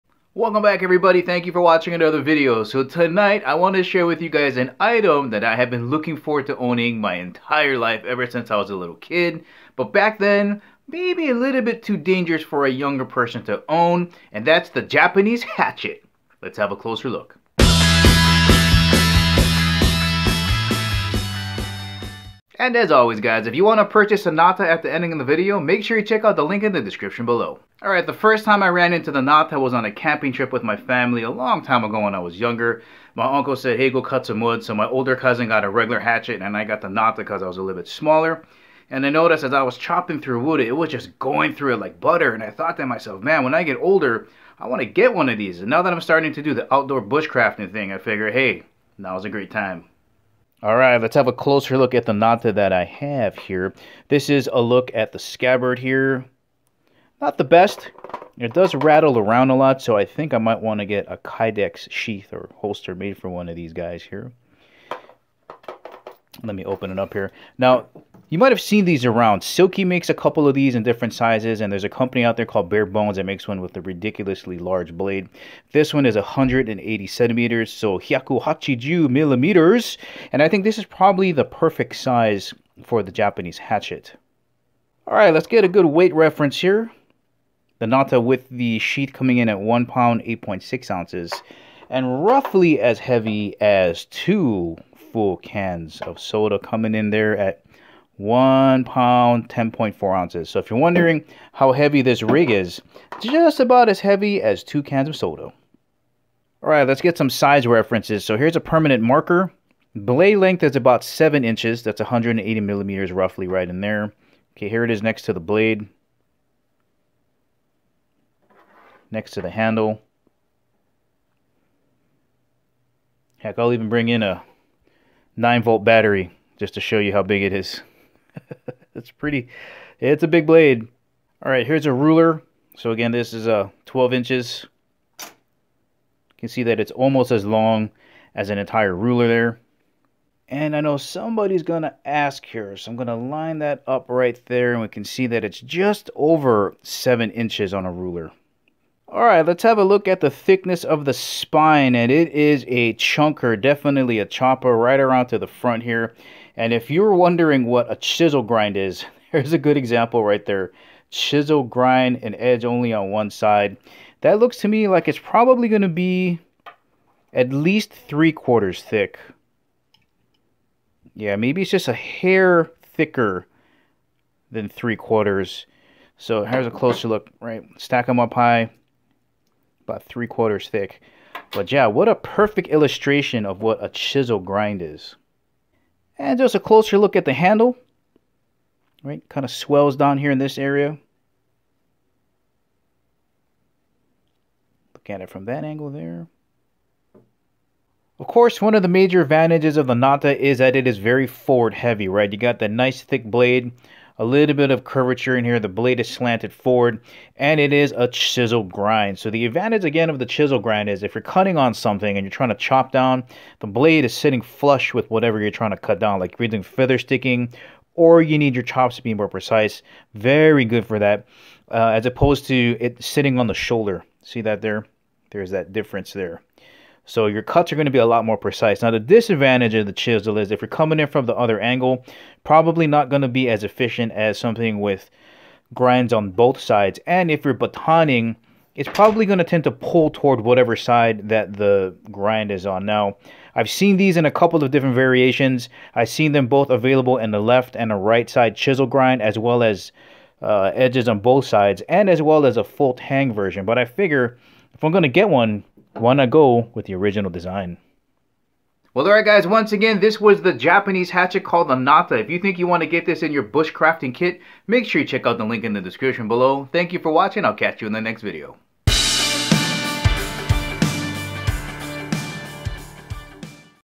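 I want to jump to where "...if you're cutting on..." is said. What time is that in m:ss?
3:31.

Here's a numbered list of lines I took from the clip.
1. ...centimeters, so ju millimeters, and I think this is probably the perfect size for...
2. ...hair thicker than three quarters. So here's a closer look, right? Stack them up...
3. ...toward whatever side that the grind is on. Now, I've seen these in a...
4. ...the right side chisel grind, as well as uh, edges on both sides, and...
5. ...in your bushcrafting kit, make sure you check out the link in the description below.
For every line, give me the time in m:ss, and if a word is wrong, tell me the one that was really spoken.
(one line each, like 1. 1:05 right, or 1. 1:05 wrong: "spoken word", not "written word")
1. 1:17 right
2. 2:51 right
3. 4:00 right
4. 4:07 right
5. 4:23 right.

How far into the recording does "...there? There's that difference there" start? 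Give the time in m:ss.
3:44.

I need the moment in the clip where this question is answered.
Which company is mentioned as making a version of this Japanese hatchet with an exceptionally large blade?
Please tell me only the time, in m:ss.
1:12.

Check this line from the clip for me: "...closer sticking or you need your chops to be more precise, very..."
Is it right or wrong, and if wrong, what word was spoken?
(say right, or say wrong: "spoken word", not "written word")
wrong: "feather", not "closer".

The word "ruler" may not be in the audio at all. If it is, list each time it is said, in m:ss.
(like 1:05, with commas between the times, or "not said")
2:11, 2:18, 2:27.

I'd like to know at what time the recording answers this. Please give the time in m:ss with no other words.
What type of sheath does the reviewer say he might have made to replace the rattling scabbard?
1:01.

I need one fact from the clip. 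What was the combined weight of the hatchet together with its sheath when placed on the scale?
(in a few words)
1 pound 8.6 ounces.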